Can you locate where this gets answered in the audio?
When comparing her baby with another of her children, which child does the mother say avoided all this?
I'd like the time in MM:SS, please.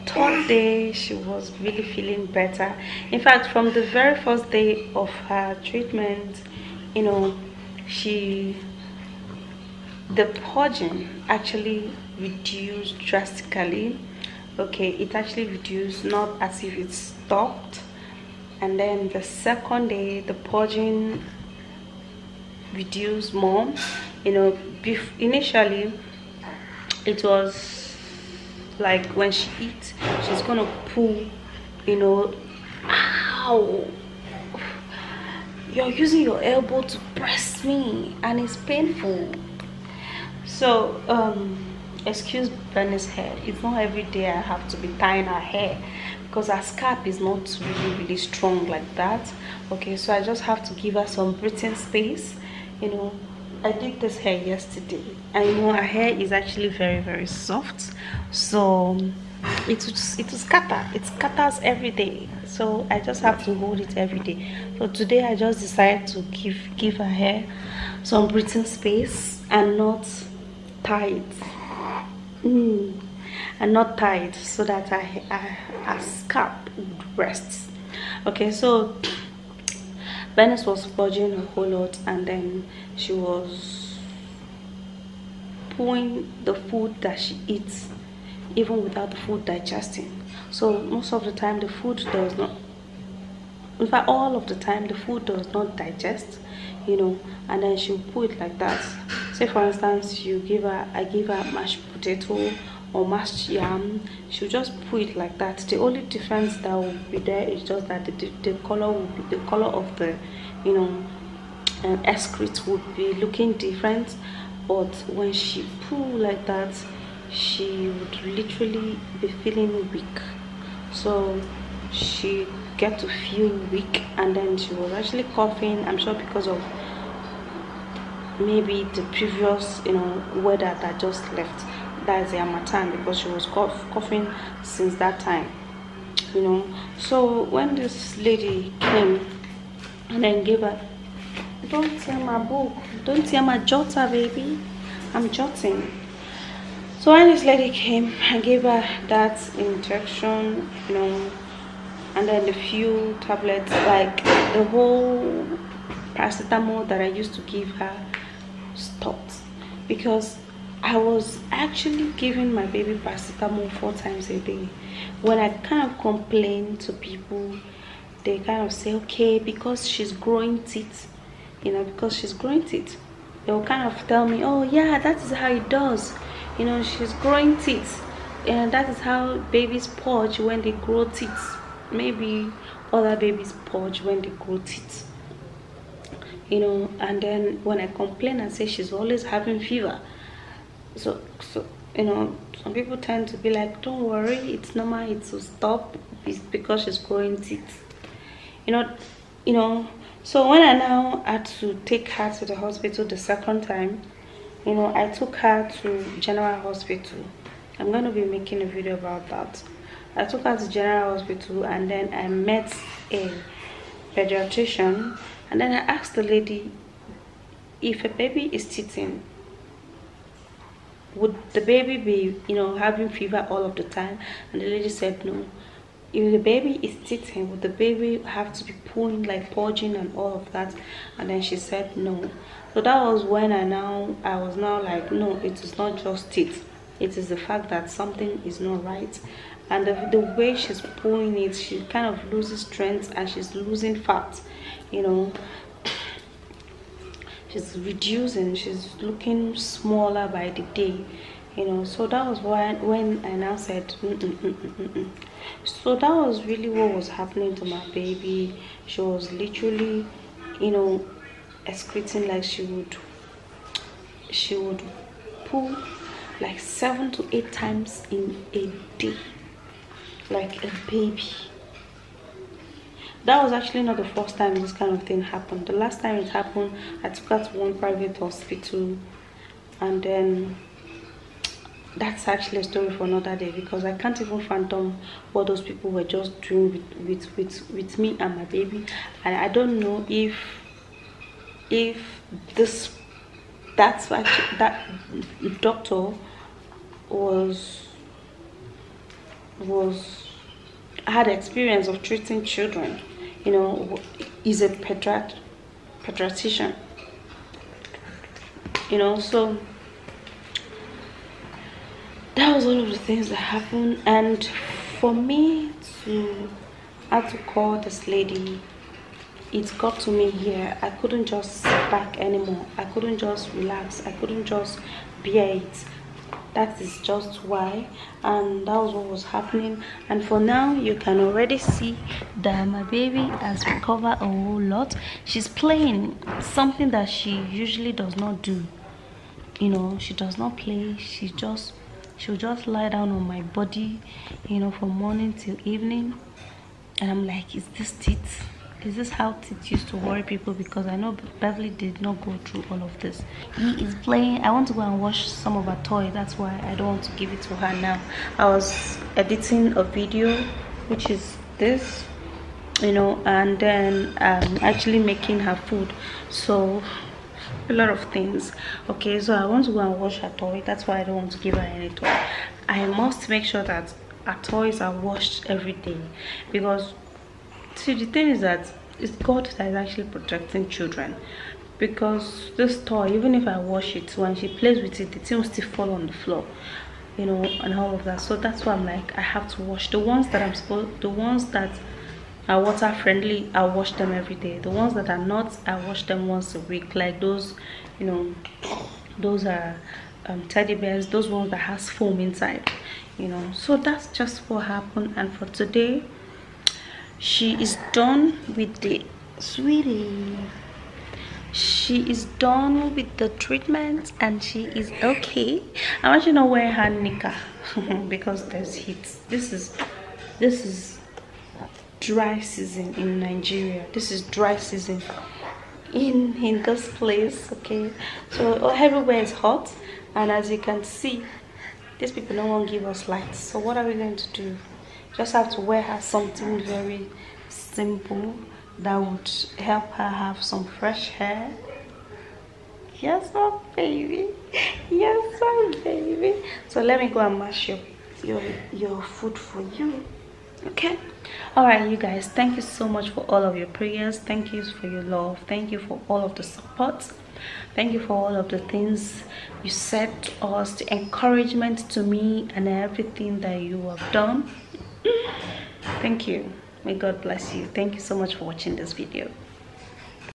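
05:51.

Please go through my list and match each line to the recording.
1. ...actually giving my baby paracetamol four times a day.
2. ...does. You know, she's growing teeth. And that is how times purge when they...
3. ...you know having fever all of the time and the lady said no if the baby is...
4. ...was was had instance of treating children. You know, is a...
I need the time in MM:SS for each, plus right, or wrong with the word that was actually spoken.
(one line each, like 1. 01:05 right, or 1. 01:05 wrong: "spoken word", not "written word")
1. 02:41 right
2. 02:55 wrong: "babies", not "times"
3. 03:42 right
4. 04:57 wrong: "experience", not "instance".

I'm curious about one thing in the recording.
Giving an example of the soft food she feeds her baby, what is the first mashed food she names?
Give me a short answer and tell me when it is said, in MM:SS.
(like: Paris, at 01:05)
mashed potato, at 01:41.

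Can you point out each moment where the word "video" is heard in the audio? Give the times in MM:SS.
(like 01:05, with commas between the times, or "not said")
03:28, 05:59, 07:48.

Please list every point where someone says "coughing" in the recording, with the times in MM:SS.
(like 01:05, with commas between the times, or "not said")
02:05, 02:13.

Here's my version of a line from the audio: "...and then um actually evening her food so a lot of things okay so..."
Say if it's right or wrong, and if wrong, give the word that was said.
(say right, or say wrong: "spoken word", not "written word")
wrong: "making", not "evening".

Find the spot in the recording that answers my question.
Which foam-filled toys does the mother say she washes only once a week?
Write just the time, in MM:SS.
06:40.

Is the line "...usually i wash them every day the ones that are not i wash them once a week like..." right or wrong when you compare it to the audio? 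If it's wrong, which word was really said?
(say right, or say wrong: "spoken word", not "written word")
wrong: "friendly", not "usually".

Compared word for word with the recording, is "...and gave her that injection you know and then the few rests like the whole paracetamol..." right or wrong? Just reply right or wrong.
wrong.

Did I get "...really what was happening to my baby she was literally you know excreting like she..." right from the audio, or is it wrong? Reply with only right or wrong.
right.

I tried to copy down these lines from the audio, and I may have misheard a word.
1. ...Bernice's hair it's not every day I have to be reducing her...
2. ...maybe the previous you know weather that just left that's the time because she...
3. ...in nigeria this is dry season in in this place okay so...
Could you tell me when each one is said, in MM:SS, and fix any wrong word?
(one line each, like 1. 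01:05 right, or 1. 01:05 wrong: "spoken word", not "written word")
1. 00:42 wrong: "tying", not "reducing"
2. 02:08 right
3. 07:02 right.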